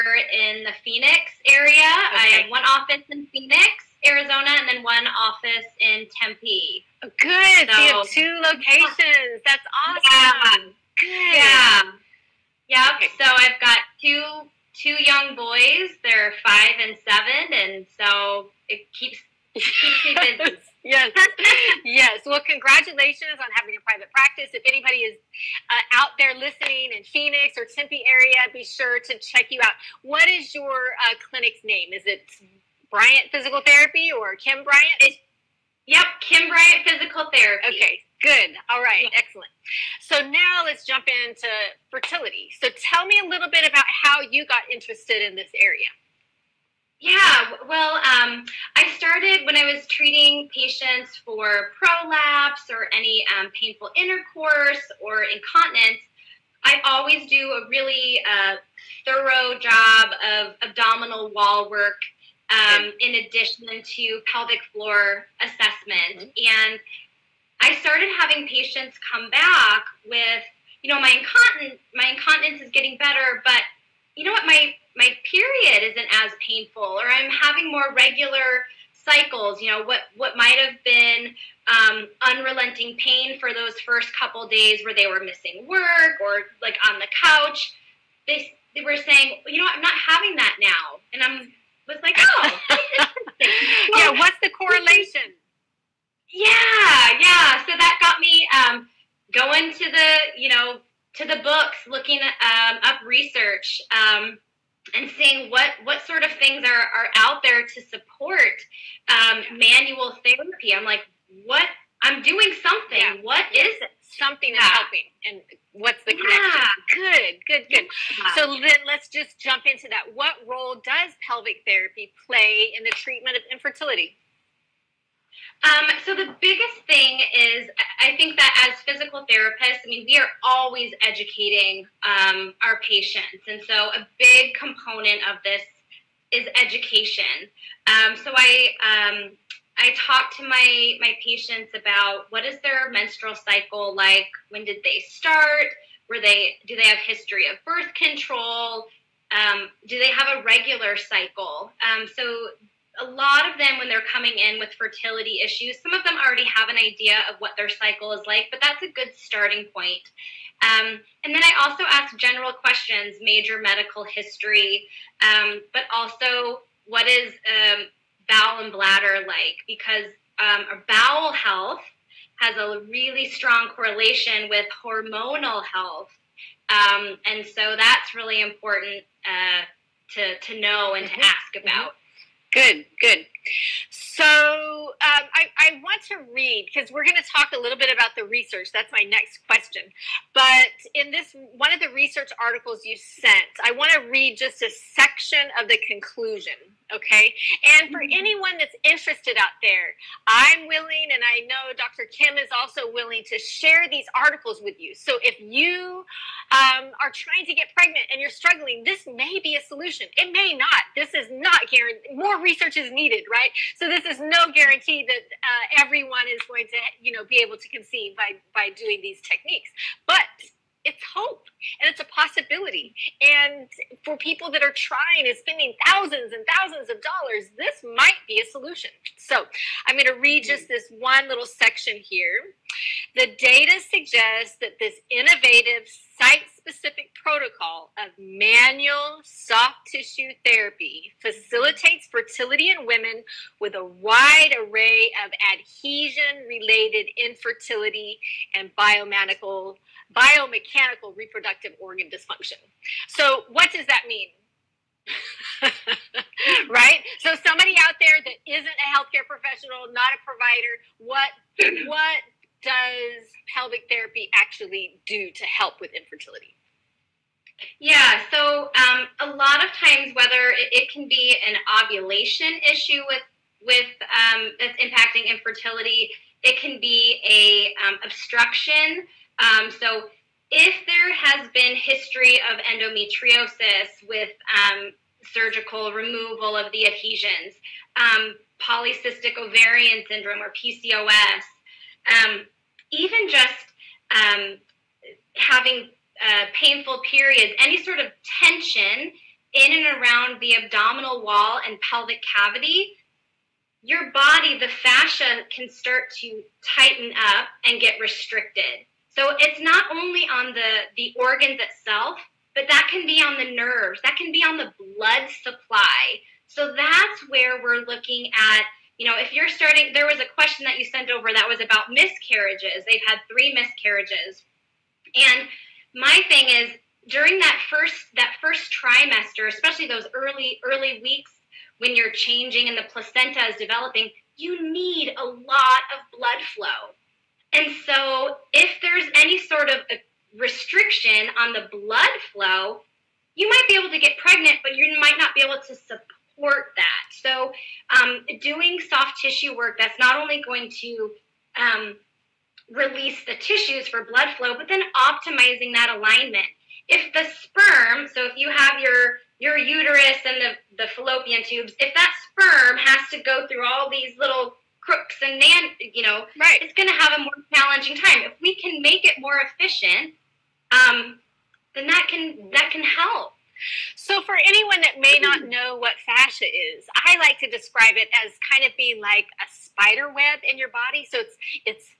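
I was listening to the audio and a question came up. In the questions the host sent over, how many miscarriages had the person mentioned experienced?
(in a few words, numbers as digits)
3.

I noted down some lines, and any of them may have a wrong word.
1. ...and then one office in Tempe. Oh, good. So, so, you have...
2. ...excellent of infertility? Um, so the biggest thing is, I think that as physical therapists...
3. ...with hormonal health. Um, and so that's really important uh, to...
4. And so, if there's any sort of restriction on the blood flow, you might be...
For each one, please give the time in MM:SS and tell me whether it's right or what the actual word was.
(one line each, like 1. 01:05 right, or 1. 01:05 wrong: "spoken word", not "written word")
1. 00:04 right
2. 02:02 wrong: "treatment", not "excellent"
3. 02:54 right
4. 05:37 right.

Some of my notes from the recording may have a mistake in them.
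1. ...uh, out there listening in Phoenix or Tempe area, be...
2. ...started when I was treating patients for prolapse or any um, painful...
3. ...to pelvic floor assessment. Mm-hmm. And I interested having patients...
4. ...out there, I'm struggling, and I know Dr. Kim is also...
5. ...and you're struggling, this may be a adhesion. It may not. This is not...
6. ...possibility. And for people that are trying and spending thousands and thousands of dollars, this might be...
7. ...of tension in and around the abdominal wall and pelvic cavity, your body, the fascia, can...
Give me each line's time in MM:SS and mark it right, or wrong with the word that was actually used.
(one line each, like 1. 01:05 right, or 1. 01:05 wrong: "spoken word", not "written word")
1. 00:25 right
2. 00:48 right
3. 01:03 wrong: "started", not "interested"
4. 03:19 wrong: "willing", not "struggling"
5. 03:28 wrong: "solution", not "adhesion"
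6. 03:42 right
7. 04:57 right.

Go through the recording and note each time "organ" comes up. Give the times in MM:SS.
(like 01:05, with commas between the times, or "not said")
04:11, 05:11.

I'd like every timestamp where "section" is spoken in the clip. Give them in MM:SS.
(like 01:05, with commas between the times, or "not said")
03:14, 03:51.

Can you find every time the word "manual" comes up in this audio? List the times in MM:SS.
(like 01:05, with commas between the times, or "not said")
01:49, 03:58.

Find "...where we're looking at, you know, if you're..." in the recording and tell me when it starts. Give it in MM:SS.
05:17.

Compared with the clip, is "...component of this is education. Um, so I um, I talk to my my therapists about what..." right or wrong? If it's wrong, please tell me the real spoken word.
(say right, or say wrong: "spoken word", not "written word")
wrong: "patients", not "therapists".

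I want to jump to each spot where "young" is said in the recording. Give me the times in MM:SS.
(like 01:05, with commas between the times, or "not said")
00:15.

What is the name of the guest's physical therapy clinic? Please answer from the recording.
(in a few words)
Kim Bryant Physical Therapy.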